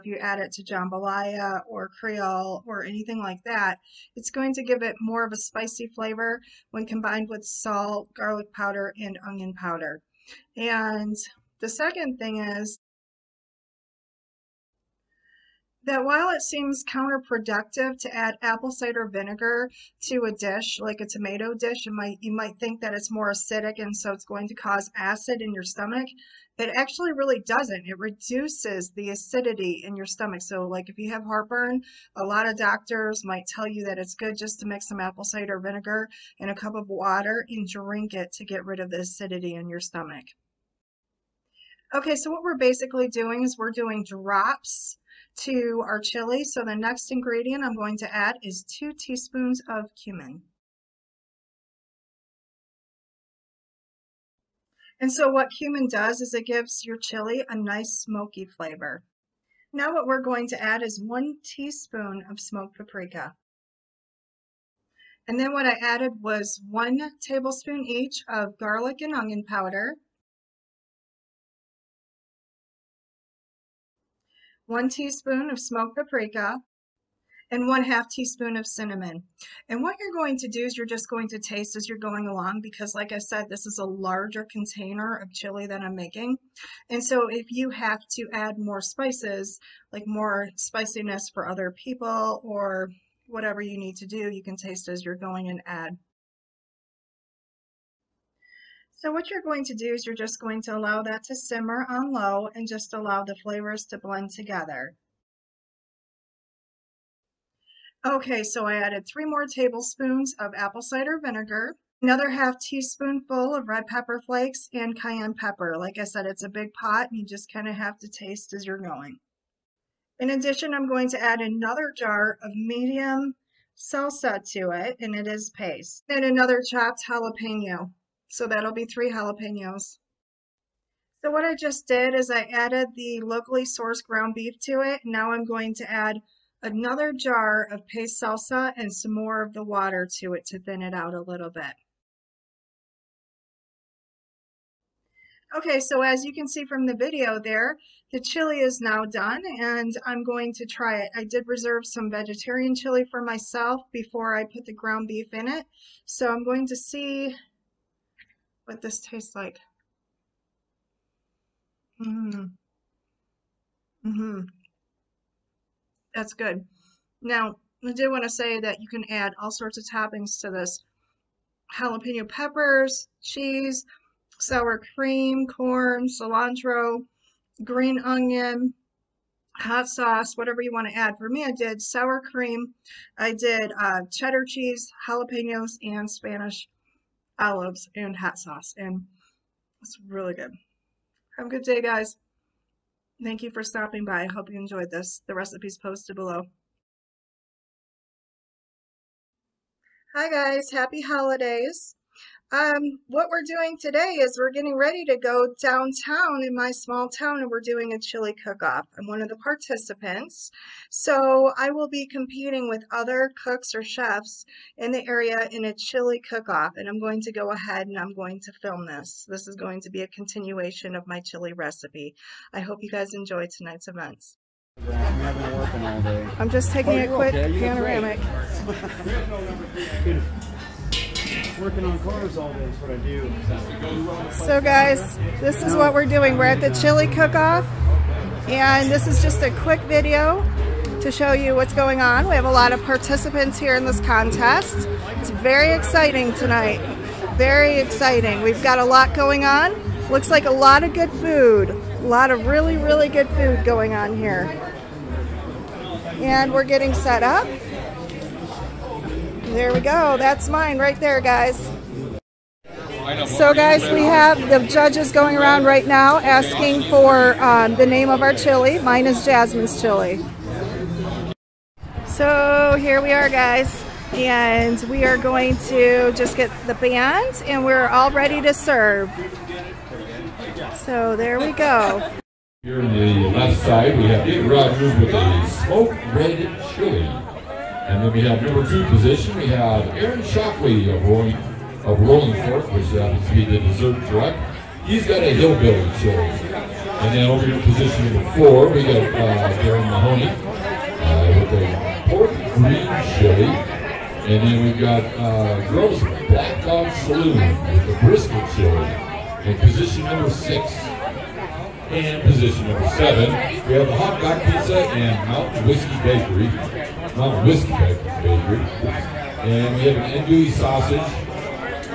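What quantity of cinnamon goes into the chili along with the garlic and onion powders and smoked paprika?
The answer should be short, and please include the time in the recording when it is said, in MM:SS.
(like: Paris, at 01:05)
1/2 teaspoon, at 01:17.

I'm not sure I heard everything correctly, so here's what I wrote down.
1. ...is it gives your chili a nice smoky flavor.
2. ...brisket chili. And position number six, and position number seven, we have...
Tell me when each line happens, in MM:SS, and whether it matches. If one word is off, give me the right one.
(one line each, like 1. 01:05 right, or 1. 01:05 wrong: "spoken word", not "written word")
1. 00:56 right
2. 05:08 right.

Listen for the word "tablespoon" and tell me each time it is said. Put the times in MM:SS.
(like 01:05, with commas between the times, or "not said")
01:07, 01:49.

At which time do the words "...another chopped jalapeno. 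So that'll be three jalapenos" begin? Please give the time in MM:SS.
02:06.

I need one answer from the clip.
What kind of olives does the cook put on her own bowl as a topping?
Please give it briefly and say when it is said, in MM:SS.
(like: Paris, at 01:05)
Spanish olives, at 03:06.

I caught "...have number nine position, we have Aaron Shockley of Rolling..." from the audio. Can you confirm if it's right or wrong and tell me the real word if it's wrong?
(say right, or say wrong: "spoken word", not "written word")
wrong: "two", not "nine".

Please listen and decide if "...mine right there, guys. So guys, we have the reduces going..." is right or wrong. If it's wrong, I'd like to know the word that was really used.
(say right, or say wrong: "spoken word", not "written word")
wrong: "judges", not "reduces".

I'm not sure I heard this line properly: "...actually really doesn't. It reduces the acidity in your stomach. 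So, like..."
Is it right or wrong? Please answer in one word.
right.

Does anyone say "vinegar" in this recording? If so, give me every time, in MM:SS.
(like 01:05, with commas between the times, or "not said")
00:19, 00:35, 01:51.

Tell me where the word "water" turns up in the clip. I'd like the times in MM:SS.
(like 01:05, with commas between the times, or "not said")
00:36, 02:19.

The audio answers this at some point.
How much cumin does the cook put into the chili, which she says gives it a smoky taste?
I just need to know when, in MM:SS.
00:48.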